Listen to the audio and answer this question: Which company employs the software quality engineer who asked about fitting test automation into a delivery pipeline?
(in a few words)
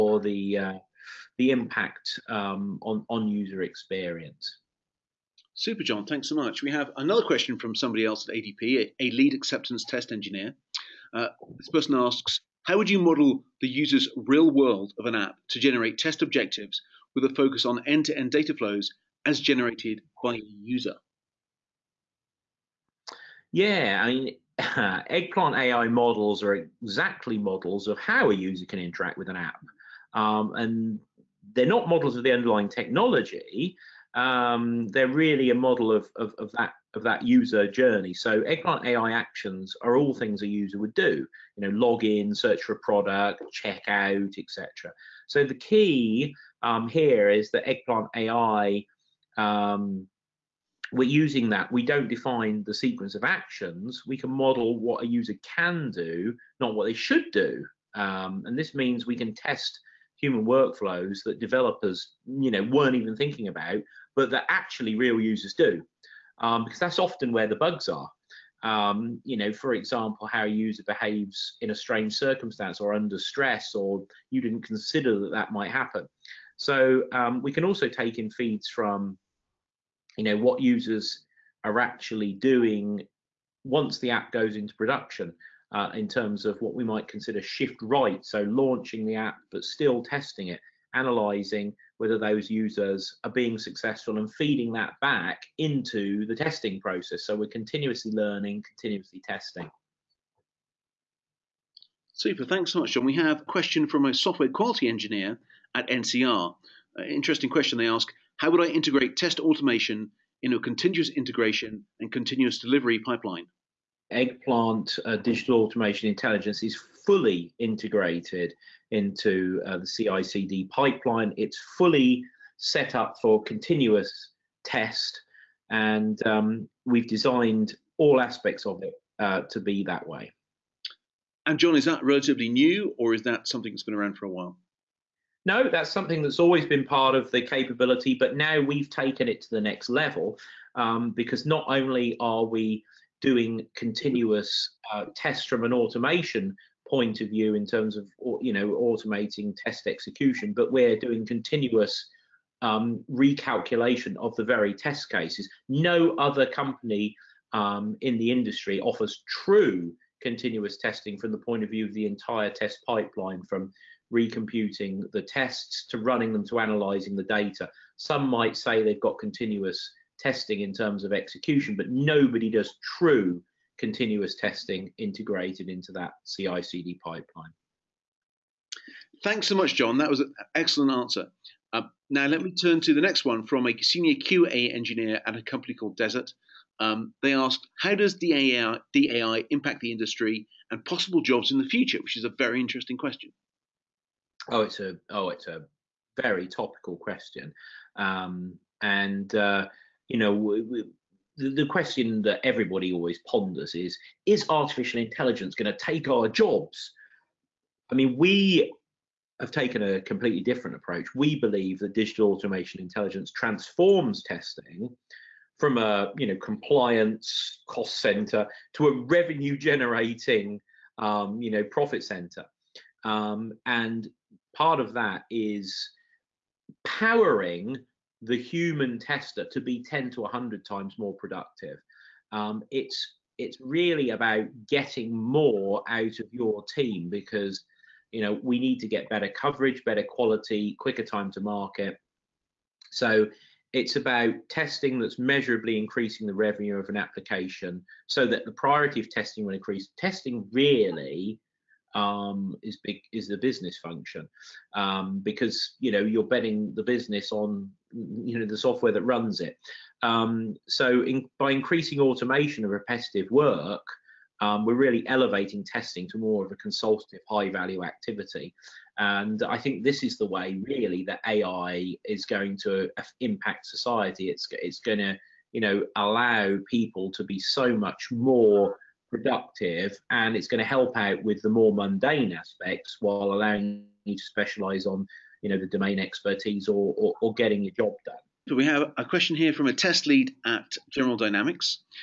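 NCR.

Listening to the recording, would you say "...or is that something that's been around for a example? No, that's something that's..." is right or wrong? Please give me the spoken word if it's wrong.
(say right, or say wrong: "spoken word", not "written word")
wrong: "while", not "example".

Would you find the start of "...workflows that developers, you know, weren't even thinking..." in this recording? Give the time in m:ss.
1:00.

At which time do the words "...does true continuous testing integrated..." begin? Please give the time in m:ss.
2:52.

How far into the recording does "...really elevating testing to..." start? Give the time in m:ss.
4:24.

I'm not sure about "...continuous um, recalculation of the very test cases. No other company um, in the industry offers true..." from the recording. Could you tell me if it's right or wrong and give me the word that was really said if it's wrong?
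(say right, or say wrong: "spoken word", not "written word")
right.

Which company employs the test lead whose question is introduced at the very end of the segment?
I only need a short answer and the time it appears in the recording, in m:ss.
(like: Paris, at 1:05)
General Dynamics, at 4:50.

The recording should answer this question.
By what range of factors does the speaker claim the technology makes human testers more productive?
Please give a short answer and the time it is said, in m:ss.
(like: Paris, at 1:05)
10 to 100 times, at 3:49.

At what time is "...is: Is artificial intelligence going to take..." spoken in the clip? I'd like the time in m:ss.
3:23.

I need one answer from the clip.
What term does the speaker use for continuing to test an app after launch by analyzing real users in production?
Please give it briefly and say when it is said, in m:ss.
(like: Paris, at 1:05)
shift right, at 1:27.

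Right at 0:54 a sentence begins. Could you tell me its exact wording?
We can model what a user can do, not what they should do.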